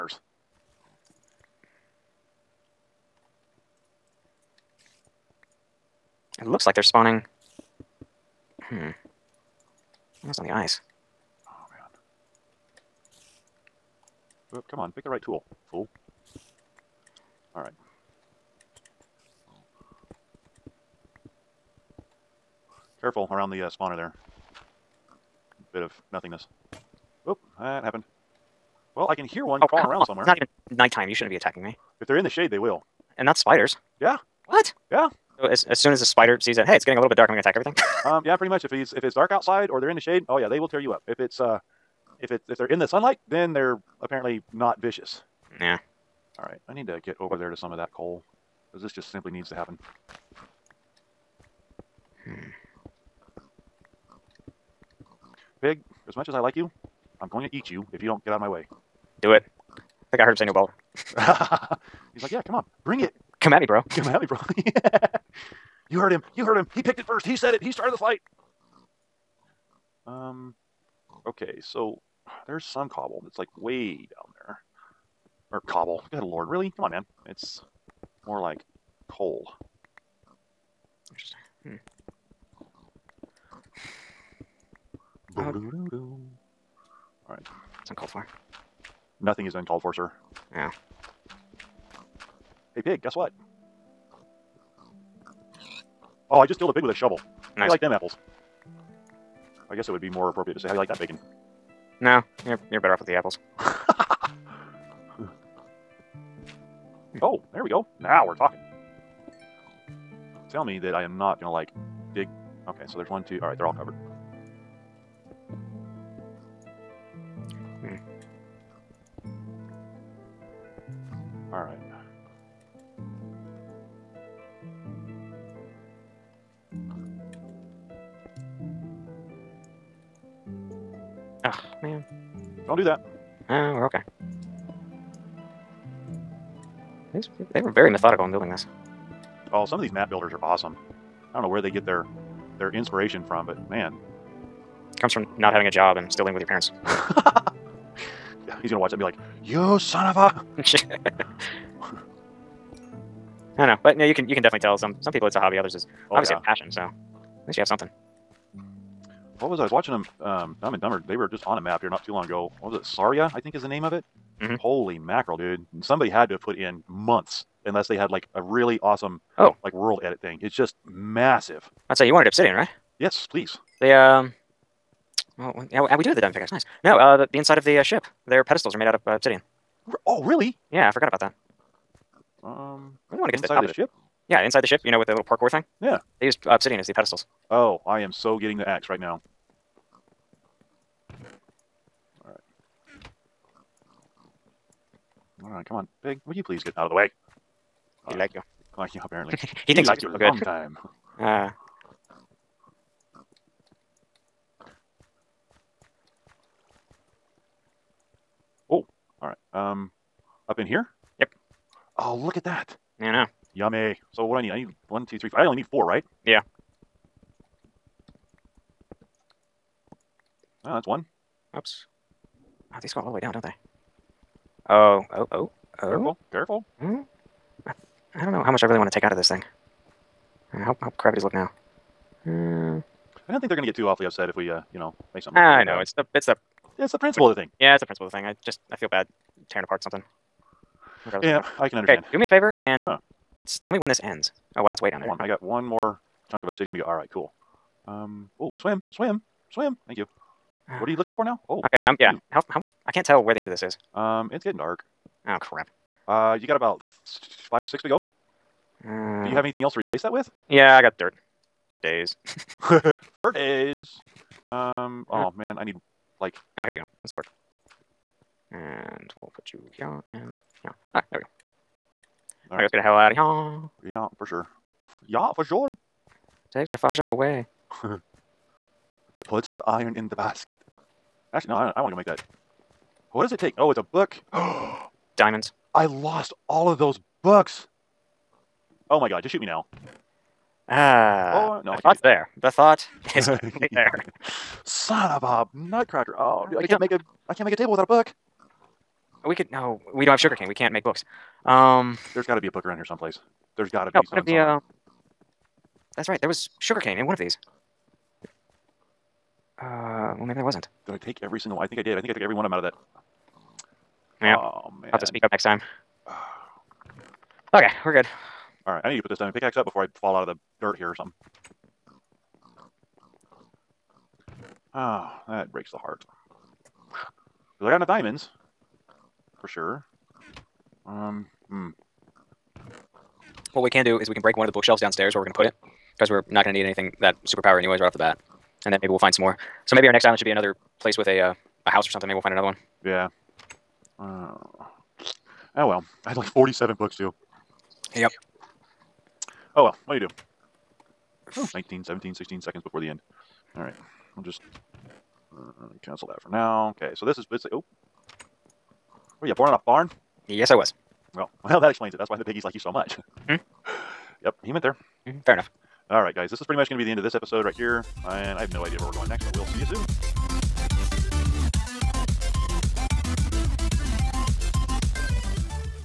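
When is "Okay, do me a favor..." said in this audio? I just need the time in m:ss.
4:02.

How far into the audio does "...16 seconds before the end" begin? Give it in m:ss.
5:52.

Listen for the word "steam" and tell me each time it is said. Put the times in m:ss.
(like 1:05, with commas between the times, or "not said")
not said.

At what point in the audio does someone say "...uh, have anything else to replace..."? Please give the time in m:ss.
4:18.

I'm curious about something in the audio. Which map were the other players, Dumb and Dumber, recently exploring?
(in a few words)
Saria.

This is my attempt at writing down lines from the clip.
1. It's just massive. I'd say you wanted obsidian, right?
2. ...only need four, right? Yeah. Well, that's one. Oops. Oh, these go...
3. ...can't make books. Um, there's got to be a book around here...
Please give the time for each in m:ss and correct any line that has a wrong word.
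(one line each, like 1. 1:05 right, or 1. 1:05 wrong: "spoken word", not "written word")
1. 2:50 right
2. 3:35 right
3. 5:00 right.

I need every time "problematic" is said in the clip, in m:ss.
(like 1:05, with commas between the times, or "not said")
not said.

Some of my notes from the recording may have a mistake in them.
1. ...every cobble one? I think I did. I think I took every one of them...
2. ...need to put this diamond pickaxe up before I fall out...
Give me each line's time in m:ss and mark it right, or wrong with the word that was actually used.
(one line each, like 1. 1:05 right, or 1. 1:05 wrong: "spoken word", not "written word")
1. 5:11 wrong: "single", not "cobble"
2. 5:18 right.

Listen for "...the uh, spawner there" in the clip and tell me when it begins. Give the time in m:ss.
0:23.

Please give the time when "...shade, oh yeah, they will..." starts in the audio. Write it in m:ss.
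0:39.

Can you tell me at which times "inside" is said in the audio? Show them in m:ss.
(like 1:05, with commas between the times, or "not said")
2:57, 3:04.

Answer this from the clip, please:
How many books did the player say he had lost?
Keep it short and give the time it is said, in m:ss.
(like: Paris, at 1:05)
47, at 5:46.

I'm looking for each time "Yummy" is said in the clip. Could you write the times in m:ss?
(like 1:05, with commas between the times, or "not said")
3:33.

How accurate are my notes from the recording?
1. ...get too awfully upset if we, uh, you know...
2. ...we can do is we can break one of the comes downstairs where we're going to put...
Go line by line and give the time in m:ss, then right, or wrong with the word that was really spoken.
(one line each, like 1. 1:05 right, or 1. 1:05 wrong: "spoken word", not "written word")
1. 3:53 right
2. 5:33 wrong: "bookshelves", not "comes".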